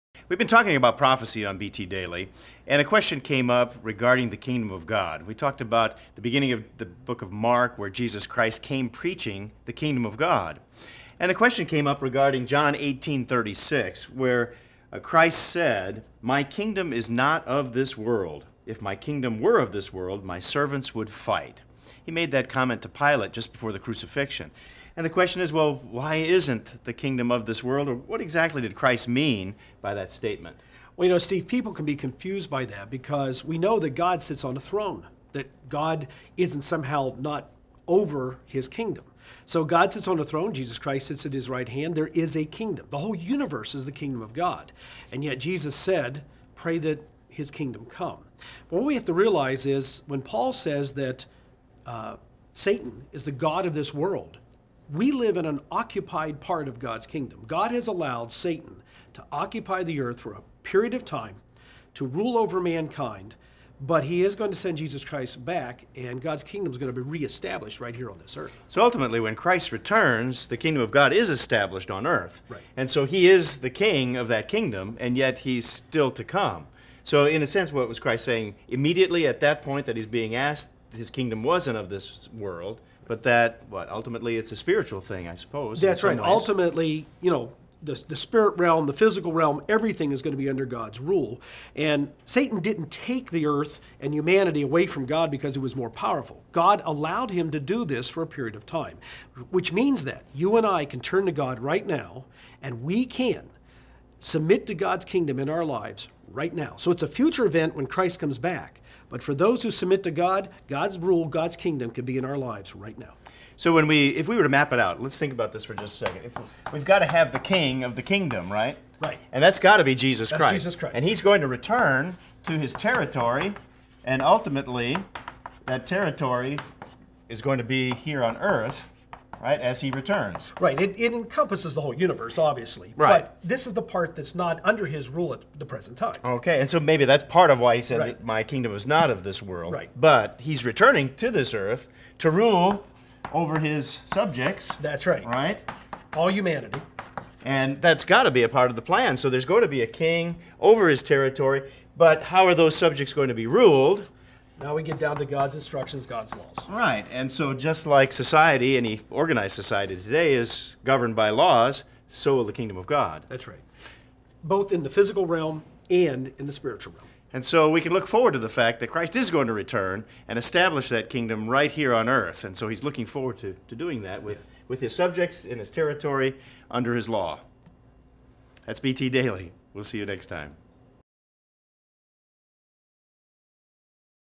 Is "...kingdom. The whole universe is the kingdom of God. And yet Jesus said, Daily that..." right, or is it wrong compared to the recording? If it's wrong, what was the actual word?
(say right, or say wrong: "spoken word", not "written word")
wrong: "Pray", not "Daily".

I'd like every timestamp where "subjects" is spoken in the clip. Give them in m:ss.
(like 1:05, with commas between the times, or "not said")
2:24, 2:32, 2:54.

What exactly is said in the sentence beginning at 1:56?
If we've got to have the King of the kingdom, right?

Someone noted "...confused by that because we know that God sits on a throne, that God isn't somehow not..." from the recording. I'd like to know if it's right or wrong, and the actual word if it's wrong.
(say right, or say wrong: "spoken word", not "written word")
right.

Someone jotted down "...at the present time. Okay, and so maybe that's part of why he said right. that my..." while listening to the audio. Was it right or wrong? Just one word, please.
right.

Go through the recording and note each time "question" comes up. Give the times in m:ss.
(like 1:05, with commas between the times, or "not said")
0:02, 0:11, 0:25.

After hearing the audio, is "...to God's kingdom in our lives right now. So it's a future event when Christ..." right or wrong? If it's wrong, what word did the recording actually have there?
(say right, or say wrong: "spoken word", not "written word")
right.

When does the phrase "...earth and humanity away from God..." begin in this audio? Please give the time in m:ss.
1:33.